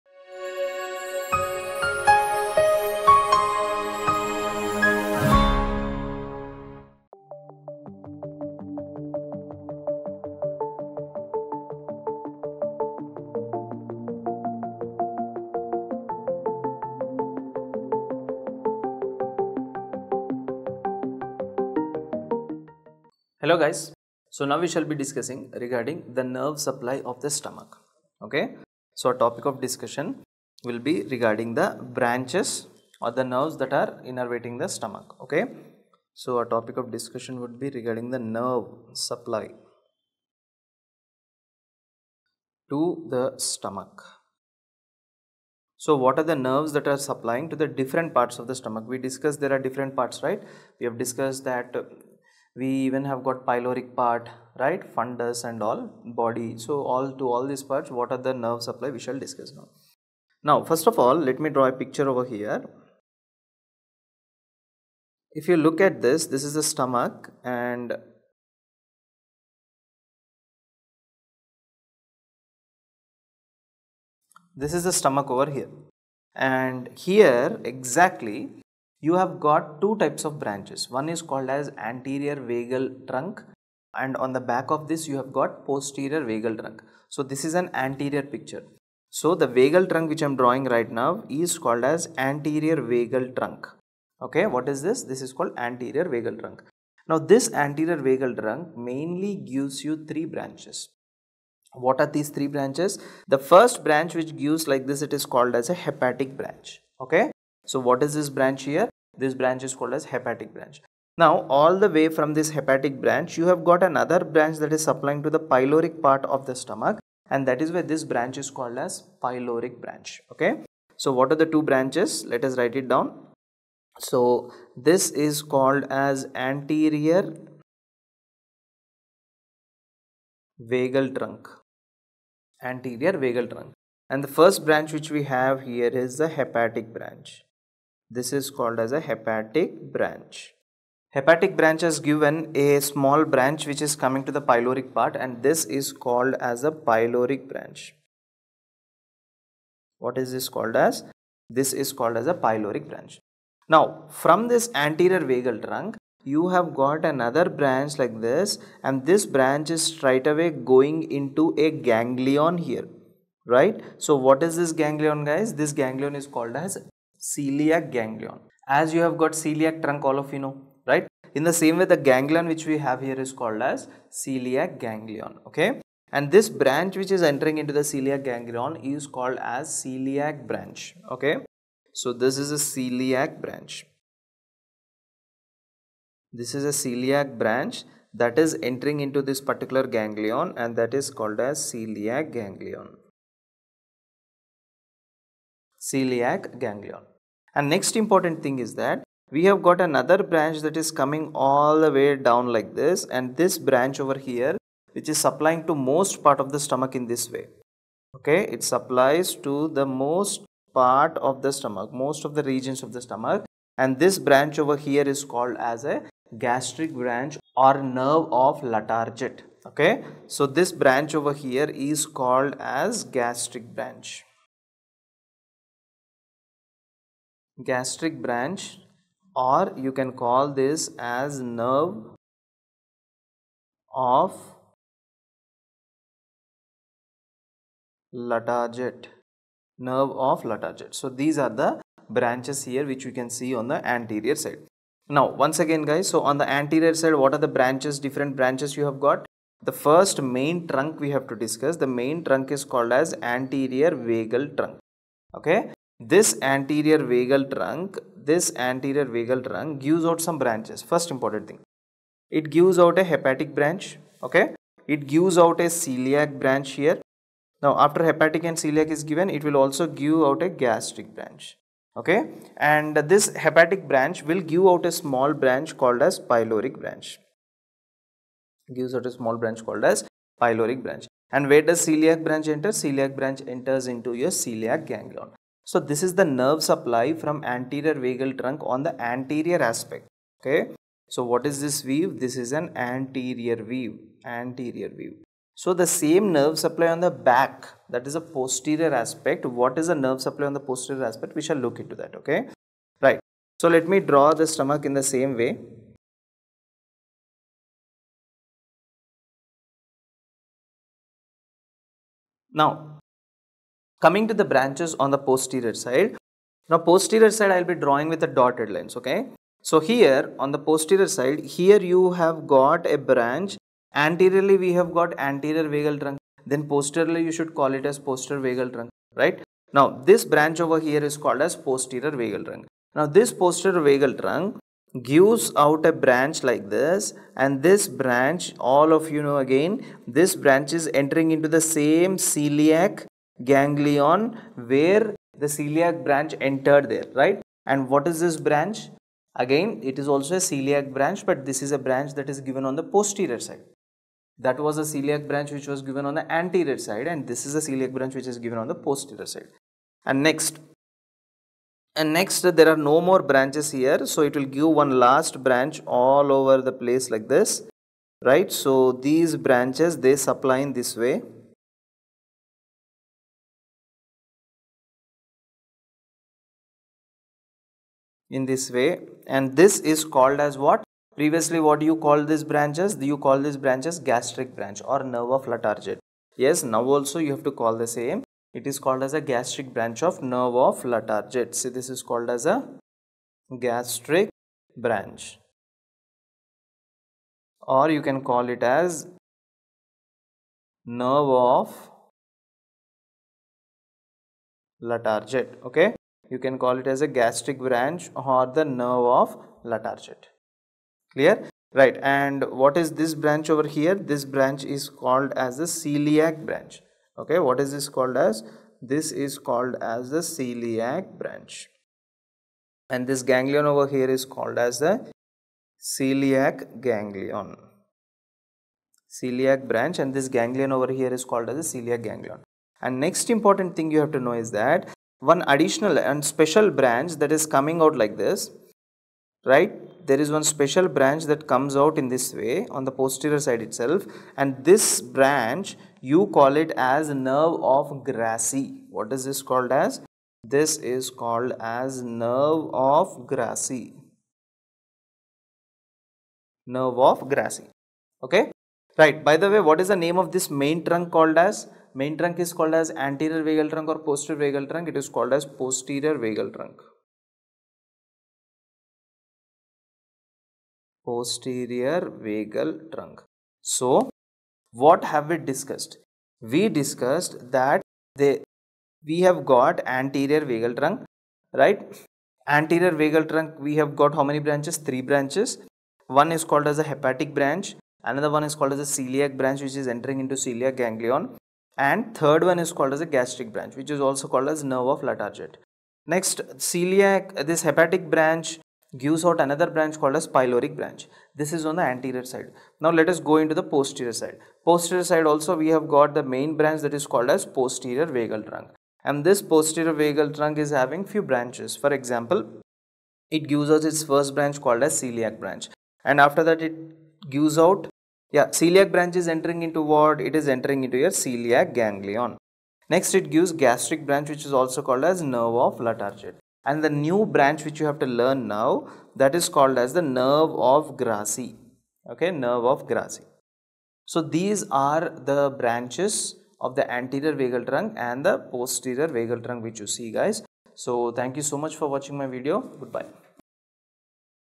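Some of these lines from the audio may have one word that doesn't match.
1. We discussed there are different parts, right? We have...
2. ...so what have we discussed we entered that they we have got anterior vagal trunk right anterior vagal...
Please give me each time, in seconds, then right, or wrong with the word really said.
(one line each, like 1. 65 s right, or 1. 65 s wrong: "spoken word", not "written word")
1. 48 s right
2. 473 s wrong: "discussed", not "entered".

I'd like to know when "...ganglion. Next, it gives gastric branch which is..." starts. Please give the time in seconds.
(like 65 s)
521 s.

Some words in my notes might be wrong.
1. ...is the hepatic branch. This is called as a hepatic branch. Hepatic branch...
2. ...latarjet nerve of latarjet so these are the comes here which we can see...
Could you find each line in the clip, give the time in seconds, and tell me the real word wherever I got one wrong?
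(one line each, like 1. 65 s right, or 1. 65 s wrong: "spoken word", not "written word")
1. 135 s right
2. 238 s wrong: "branches", not "comes".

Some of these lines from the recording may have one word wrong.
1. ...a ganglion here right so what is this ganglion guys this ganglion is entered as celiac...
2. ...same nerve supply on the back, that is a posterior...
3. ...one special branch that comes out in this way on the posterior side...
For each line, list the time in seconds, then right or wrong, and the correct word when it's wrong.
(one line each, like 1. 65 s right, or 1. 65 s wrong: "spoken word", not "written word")
1. 161 s wrong: "called", not "entered"
2. 295 s right
3. 440 s right.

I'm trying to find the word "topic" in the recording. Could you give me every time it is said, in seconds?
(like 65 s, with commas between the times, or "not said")
29 s, 36 s.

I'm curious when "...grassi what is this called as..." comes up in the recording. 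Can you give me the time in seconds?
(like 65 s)
448 s.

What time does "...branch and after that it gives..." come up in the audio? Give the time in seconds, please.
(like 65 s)
515 s.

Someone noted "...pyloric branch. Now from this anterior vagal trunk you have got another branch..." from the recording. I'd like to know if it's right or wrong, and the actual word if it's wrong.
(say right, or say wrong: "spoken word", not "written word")
right.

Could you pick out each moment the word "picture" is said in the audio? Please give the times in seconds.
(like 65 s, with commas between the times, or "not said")
61 s, 88 s.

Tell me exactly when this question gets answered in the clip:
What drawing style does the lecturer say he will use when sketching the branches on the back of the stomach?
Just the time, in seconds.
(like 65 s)
318 s.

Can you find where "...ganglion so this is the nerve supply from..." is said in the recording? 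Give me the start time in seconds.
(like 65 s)
284 s.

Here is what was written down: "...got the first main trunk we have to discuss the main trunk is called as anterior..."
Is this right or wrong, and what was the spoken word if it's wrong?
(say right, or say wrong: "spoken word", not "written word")
right.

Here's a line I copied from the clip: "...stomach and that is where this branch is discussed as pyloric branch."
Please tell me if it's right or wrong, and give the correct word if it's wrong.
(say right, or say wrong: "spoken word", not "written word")
wrong: "called", not "discussed".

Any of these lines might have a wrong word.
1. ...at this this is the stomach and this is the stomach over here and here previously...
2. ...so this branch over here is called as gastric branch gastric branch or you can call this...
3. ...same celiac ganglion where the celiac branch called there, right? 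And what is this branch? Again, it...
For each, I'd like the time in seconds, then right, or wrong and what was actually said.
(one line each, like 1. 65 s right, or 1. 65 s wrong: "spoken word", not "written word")
1. 65 s wrong: "exactly", not "previously"
2. 220 s right
3. 341 s wrong: "entered", not "called".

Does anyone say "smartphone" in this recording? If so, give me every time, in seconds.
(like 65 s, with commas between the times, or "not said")
not said.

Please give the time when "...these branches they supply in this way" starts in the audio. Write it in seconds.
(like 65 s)
368 s.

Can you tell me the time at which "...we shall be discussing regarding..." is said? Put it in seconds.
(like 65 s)
24 s.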